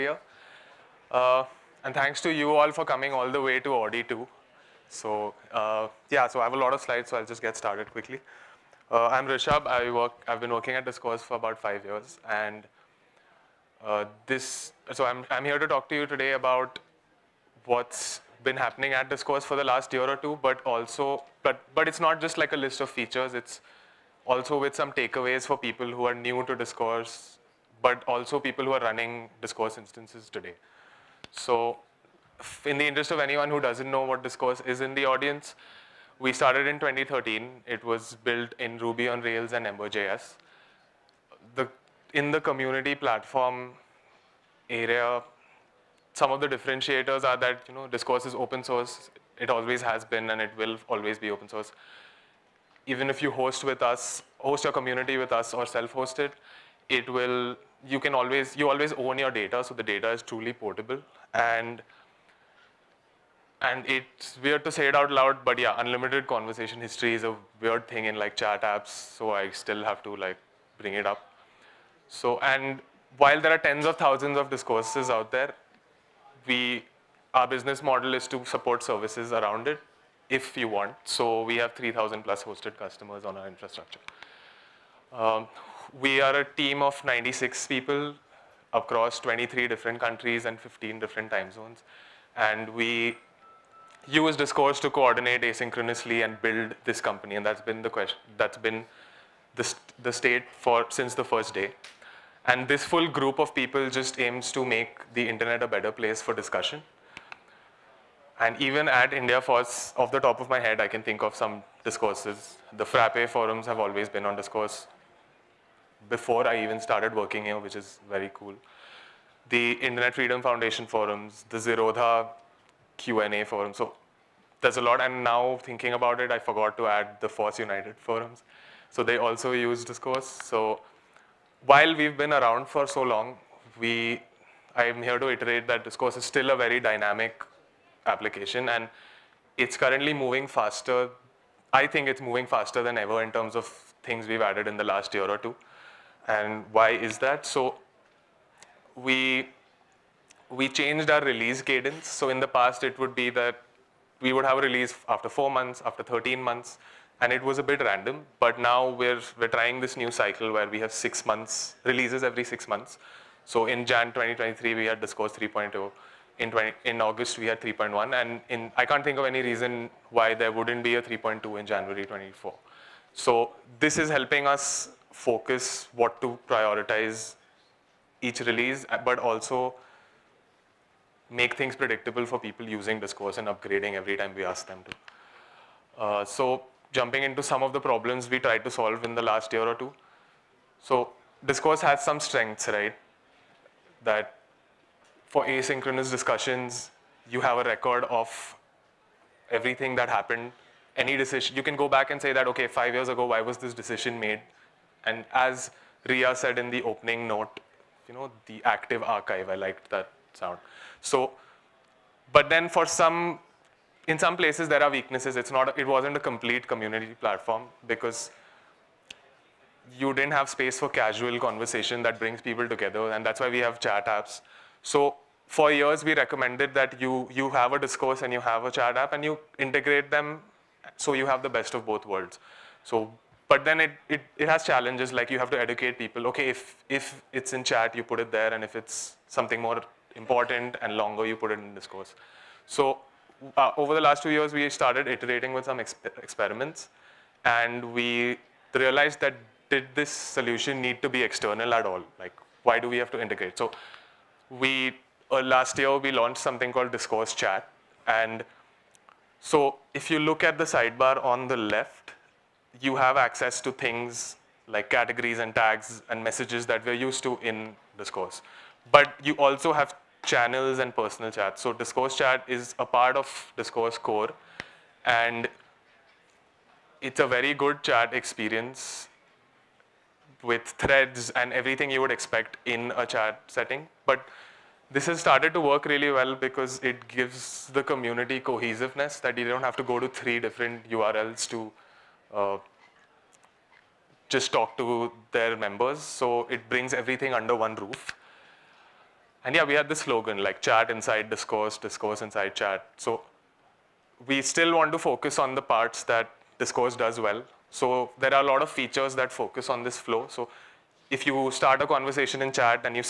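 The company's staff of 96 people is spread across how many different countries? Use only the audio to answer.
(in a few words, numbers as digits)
23.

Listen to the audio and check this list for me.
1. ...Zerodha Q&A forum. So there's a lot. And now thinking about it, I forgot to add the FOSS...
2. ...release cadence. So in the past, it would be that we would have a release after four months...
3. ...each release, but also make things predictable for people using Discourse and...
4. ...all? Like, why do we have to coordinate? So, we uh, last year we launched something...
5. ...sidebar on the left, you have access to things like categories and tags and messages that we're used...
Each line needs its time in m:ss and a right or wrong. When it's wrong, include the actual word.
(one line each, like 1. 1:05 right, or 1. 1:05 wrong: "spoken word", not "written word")
1. 2:01 right
2. 2:31 right
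3. 2:58 right
4. 4:11 wrong: "integrate", not "coordinate"
5. 4:20 right.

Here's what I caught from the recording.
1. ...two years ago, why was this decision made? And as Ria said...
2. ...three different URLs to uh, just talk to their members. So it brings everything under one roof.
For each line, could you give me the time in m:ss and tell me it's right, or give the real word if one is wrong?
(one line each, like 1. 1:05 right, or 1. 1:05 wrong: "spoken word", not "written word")
1. 3:22 wrong: "five", not "two"
2. 4:50 right.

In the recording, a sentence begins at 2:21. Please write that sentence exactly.
I think it's moving faster than ever in terms of things we've added in the last year or two.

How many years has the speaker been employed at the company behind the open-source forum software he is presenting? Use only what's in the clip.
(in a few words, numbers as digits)
5 years.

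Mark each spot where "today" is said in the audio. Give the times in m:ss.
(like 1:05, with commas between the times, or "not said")
0:16, 0:30.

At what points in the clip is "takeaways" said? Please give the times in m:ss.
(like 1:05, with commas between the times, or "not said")
0:24.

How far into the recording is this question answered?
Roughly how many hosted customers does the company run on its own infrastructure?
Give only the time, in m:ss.
1:21.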